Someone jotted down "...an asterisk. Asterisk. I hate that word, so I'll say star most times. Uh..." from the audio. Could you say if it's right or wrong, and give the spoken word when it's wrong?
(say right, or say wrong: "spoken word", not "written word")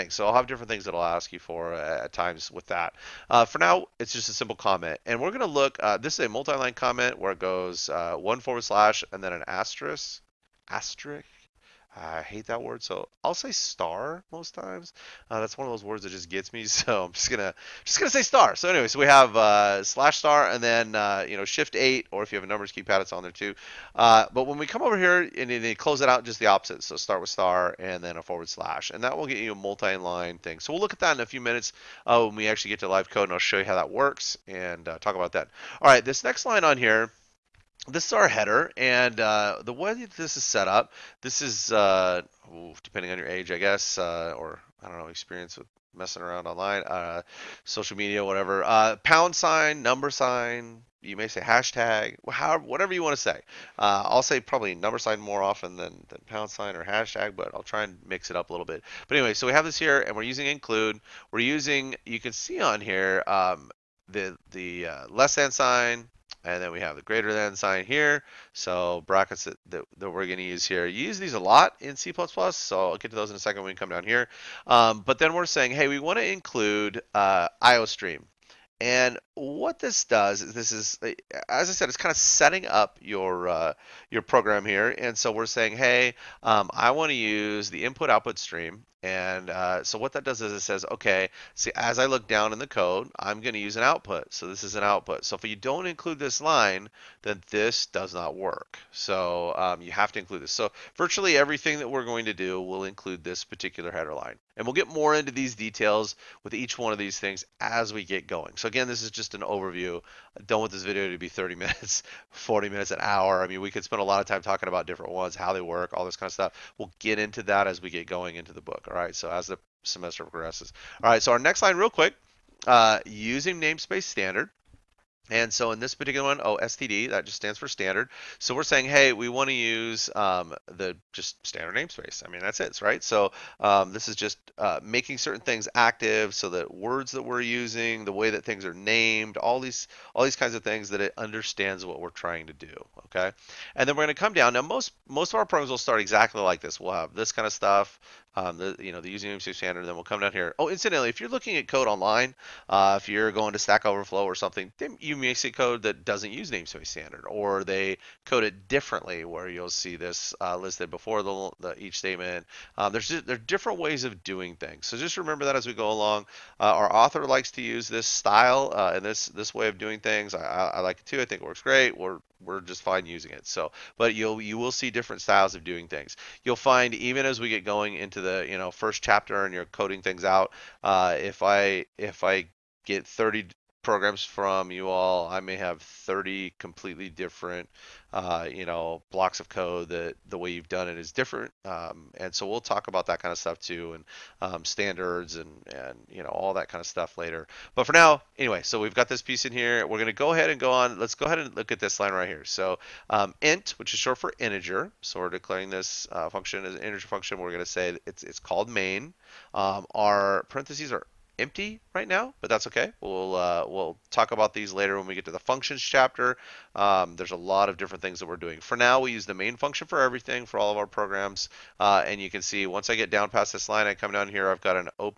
right.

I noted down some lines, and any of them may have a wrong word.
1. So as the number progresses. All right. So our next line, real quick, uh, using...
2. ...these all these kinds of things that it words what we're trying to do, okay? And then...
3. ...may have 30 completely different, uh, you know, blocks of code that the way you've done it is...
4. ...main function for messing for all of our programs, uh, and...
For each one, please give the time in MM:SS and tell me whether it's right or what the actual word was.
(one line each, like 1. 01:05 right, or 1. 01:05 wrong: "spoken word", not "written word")
1. 01:59 wrong: "semester", not "number"
2. 02:19 wrong: "understands", not "words"
3. 03:05 right
4. 03:39 wrong: "everything", not "messing".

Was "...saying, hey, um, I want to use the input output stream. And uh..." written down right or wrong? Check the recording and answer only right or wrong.
right.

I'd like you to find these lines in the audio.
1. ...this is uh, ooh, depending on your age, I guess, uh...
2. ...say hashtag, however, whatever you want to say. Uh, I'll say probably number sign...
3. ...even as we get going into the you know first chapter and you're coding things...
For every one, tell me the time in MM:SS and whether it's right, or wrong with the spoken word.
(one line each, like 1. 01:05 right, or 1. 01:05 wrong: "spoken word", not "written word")
1. 00:41 right
2. 00:51 right
3. 02:56 right.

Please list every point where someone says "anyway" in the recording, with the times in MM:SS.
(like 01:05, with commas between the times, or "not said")
00:18, 00:59, 03:18.